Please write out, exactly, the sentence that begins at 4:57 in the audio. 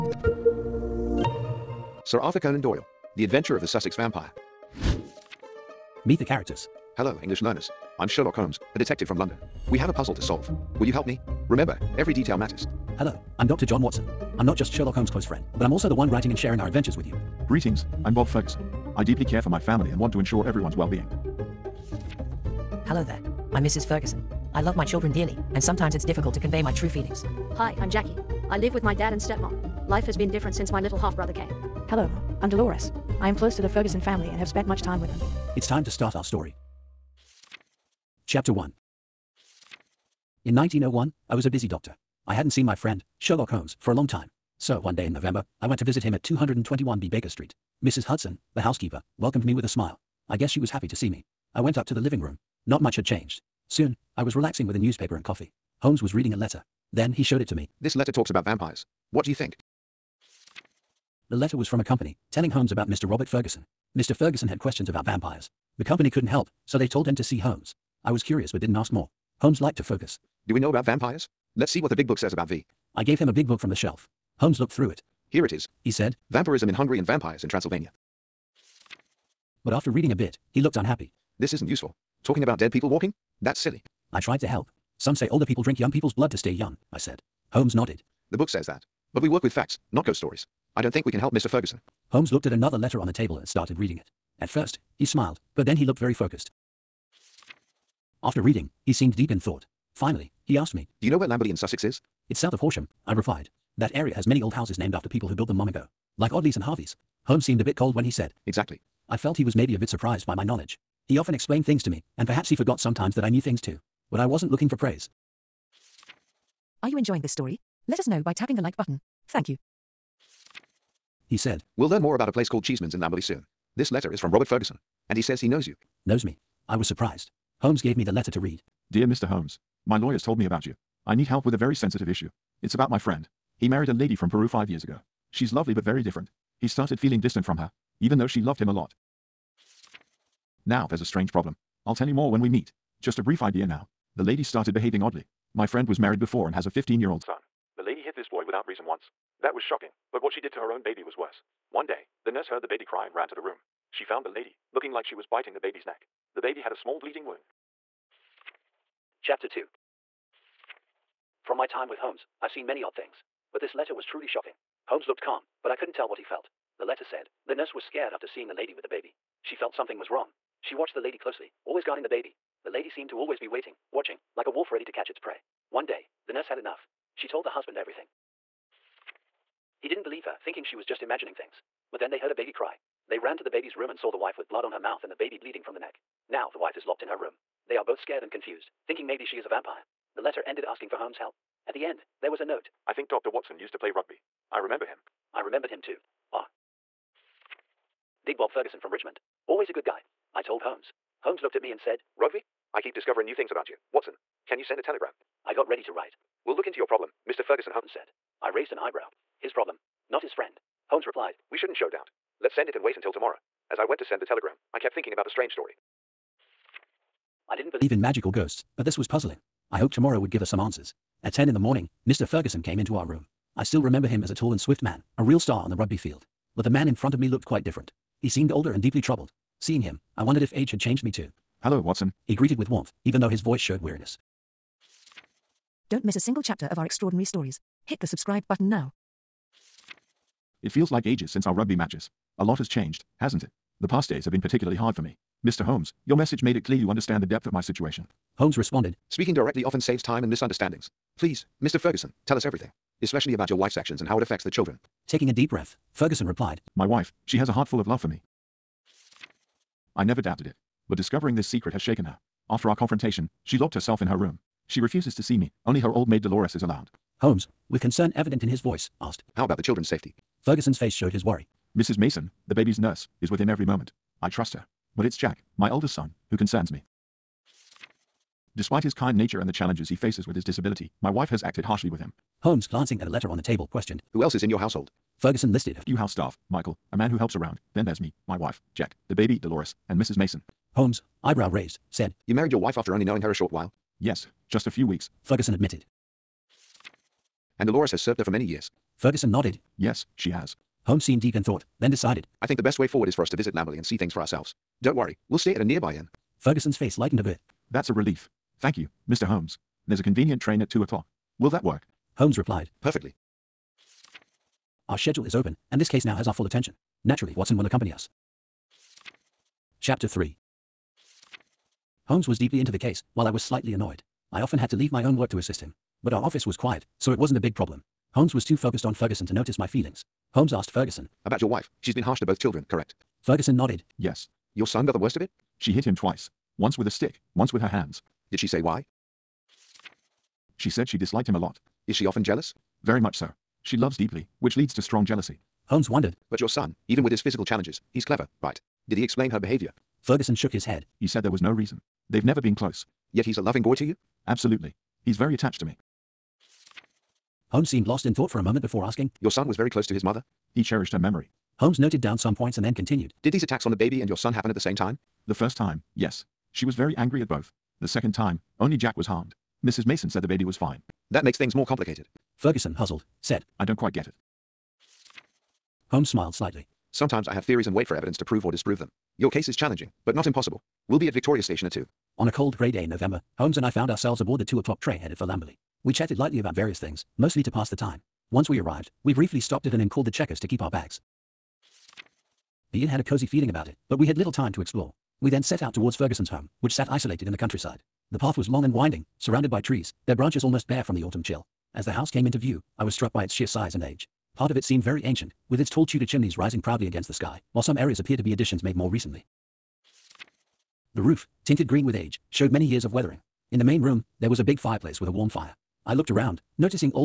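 and Dolores has served her for many years.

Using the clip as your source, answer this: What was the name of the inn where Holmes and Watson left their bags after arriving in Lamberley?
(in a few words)
The Checkers.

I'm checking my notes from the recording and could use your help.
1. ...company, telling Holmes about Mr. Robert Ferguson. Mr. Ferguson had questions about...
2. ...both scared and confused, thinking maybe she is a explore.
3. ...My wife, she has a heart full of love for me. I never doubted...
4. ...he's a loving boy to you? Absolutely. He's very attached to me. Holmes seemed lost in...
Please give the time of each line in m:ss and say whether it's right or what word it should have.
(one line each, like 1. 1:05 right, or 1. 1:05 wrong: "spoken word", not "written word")
1. 1:01 right
2. 3:07 wrong: "vampire", not "explore"
3. 4:16 right
4. 5:53 right.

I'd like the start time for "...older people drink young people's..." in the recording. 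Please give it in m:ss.
1:25.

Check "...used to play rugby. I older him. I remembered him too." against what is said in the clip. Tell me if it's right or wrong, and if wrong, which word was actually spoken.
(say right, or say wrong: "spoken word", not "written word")
wrong: "remember", not "older".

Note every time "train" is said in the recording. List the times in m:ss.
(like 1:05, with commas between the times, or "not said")
5:10, 6:24.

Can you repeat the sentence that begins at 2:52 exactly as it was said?
The lady seemed to always be waiting, watching, like a wolf ready to catch its prey.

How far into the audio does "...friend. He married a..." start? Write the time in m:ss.
2:12.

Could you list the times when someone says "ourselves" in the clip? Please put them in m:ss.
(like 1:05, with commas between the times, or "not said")
5:04, 6:23.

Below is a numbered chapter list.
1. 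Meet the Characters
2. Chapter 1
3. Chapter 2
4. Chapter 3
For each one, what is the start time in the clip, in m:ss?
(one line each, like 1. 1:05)
1. 0:05
2. 0:37
3. 2:38
4. 5:19.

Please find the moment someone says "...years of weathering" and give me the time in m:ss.
6:52.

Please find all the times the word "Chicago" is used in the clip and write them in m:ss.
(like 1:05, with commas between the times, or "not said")
not said.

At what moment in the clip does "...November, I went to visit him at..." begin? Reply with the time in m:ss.
0:45.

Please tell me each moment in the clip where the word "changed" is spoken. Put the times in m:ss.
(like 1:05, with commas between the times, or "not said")
0:53, 3:50, 4:02.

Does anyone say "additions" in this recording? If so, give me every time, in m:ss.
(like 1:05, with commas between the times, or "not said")
6:48.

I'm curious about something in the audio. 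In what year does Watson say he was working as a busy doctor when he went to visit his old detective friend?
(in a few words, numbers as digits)
1901.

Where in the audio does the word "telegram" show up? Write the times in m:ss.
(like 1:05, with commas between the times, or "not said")
3:24, 3:34.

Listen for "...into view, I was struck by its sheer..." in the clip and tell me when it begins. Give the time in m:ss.
6:42.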